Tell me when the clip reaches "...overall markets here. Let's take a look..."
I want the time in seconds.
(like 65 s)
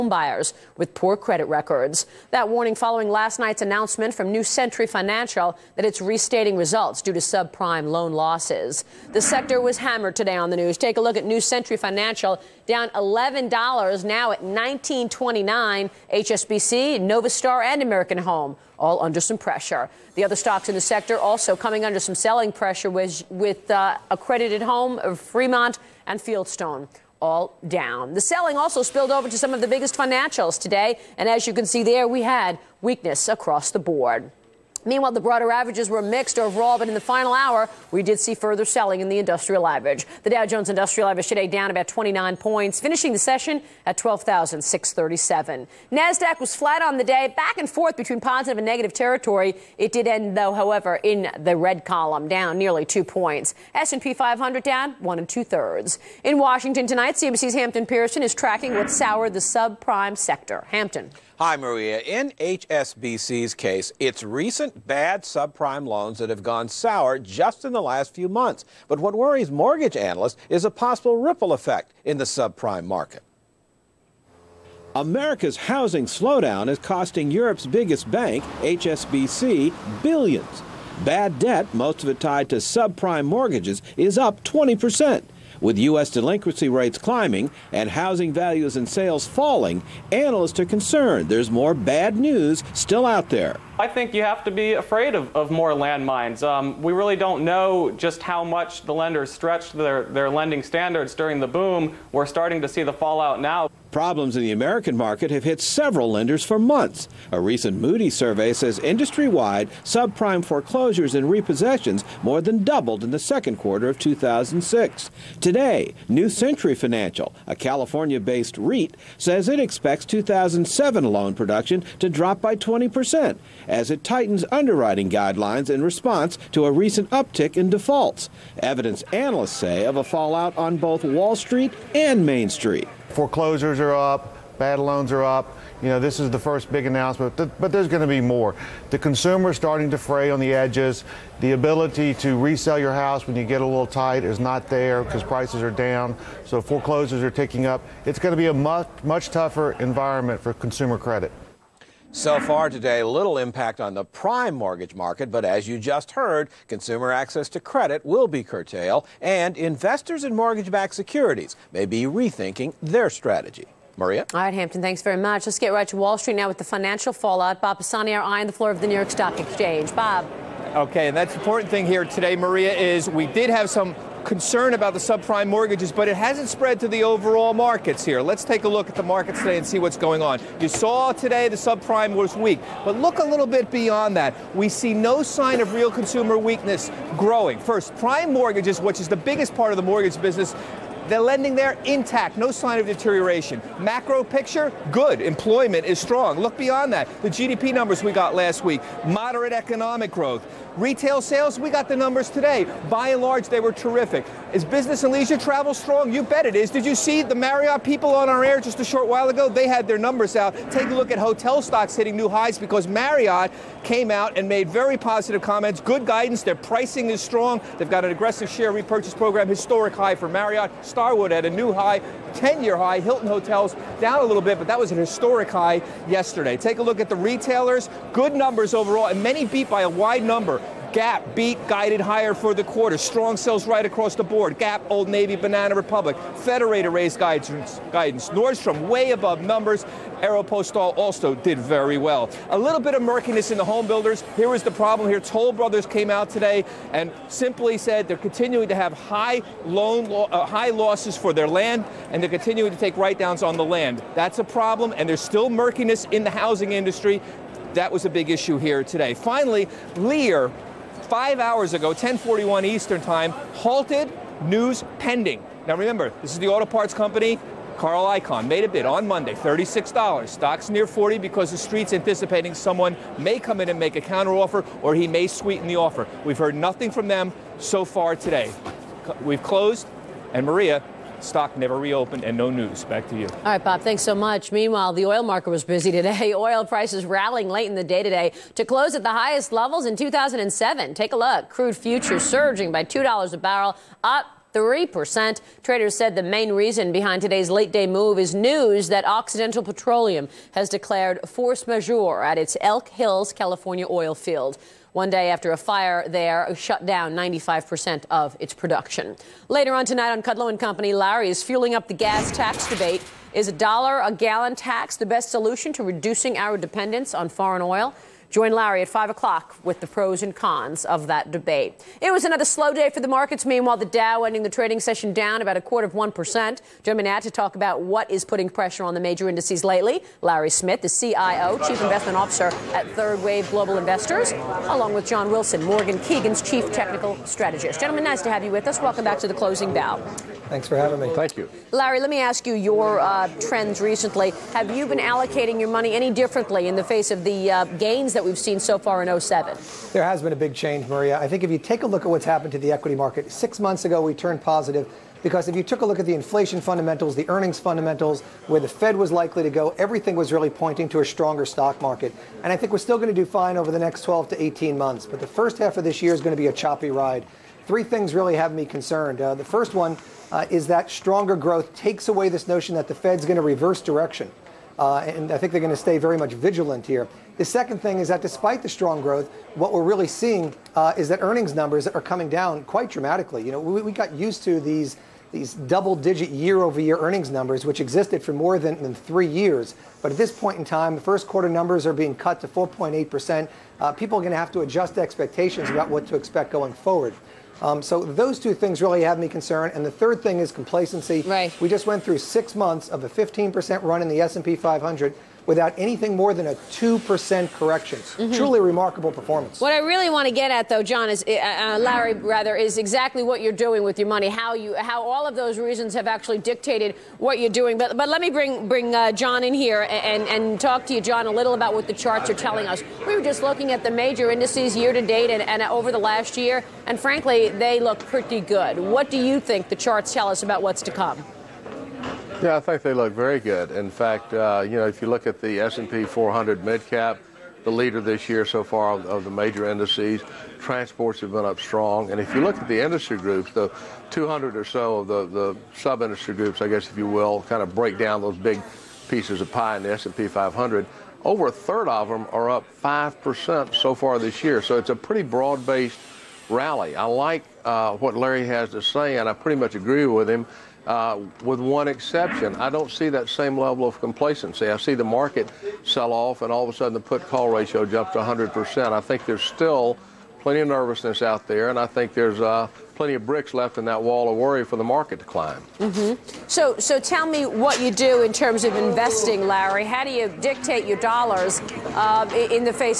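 177 s.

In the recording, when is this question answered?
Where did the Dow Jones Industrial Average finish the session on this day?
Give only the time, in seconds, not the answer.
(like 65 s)
43 s.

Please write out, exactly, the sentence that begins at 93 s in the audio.
I think you have to be afraid of, of more landmines.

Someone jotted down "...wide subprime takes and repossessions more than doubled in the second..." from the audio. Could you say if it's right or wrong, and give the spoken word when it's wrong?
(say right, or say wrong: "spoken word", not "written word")
wrong: "foreclosures", not "takes".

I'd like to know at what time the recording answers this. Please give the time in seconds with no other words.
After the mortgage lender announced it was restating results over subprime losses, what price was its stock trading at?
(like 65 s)
14 s.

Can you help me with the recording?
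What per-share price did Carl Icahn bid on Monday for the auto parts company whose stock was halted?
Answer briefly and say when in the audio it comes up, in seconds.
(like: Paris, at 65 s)
$36, at 269 s.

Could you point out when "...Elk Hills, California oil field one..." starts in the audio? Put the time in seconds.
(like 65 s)
302 s.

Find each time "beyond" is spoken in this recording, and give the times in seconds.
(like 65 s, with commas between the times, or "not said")
183 s, 196 s.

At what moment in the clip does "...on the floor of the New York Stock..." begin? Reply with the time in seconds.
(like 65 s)
168 s.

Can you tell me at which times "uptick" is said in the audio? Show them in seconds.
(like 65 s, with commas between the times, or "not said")
127 s.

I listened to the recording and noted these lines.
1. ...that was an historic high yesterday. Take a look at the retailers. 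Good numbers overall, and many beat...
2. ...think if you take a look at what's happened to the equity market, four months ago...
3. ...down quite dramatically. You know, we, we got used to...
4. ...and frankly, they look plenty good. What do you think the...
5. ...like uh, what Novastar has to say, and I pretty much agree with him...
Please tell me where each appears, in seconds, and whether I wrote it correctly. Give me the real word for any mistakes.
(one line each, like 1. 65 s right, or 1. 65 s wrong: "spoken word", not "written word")
1. 224 s right
2. 351 s wrong: "six", not "four"
3. 382 s right
4. 426 s wrong: "pretty", not "plenty"
5. 457 s wrong: "Larry", not "Novastar".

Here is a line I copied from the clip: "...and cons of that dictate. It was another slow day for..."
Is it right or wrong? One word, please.
wrong.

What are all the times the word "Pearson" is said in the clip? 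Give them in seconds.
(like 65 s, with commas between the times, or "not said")
57 s.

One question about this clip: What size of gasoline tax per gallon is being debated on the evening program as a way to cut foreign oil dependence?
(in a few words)
a dollar.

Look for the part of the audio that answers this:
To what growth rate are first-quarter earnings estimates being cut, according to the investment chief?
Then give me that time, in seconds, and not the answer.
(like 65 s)
392 s.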